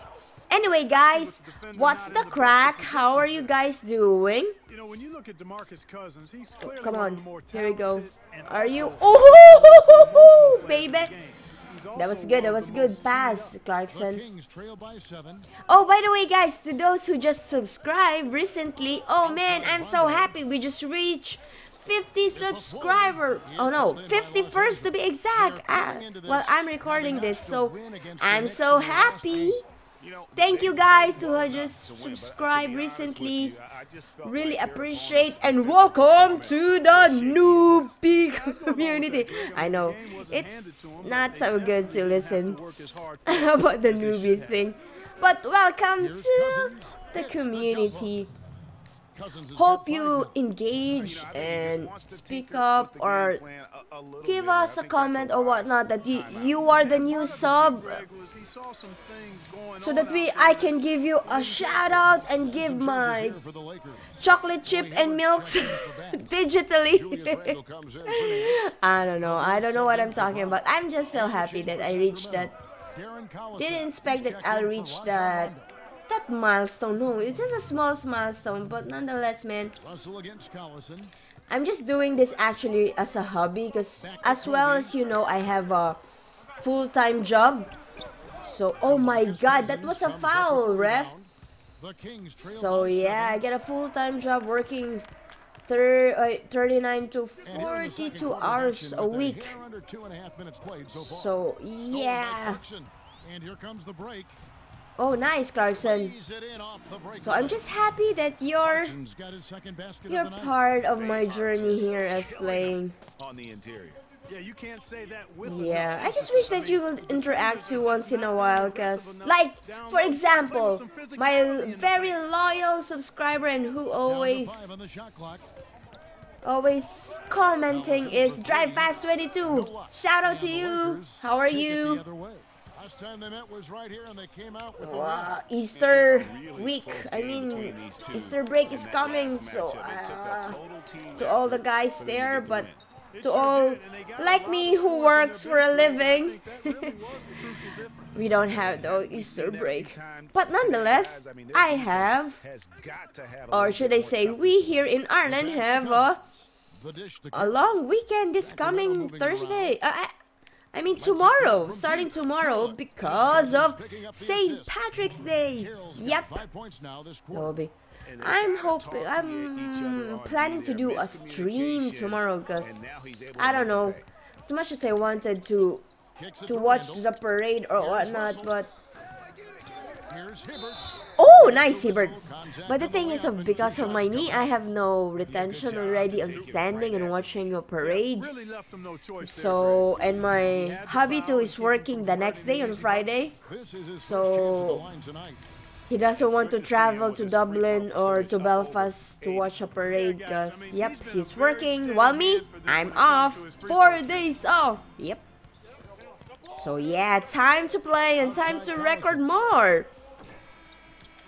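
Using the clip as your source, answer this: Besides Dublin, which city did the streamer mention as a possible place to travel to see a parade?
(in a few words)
Belfast.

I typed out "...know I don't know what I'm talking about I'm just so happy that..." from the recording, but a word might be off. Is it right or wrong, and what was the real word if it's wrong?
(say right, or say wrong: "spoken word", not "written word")
right.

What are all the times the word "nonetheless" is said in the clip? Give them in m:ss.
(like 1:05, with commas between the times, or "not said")
1:18, 2:30.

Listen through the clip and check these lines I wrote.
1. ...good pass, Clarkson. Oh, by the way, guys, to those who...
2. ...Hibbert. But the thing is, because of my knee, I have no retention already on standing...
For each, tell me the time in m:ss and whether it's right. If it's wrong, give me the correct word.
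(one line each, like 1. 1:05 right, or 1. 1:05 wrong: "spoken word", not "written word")
1. 0:12 right
2. 3:01 right.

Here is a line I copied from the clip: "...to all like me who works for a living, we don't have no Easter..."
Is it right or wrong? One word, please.
right.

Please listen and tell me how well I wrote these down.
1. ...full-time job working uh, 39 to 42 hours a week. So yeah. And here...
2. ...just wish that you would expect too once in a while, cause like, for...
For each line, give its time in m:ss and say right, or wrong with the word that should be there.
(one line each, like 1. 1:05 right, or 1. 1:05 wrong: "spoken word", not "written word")
1. 1:33 right
2. 1:56 wrong: "interact", not "expect".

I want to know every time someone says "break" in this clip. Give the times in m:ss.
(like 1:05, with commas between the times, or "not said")
1:43, 2:18, 2:29.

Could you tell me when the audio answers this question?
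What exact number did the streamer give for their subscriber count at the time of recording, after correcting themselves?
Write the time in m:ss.
0:24.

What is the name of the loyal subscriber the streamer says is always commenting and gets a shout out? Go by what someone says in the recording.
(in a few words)
Drive Fast 22.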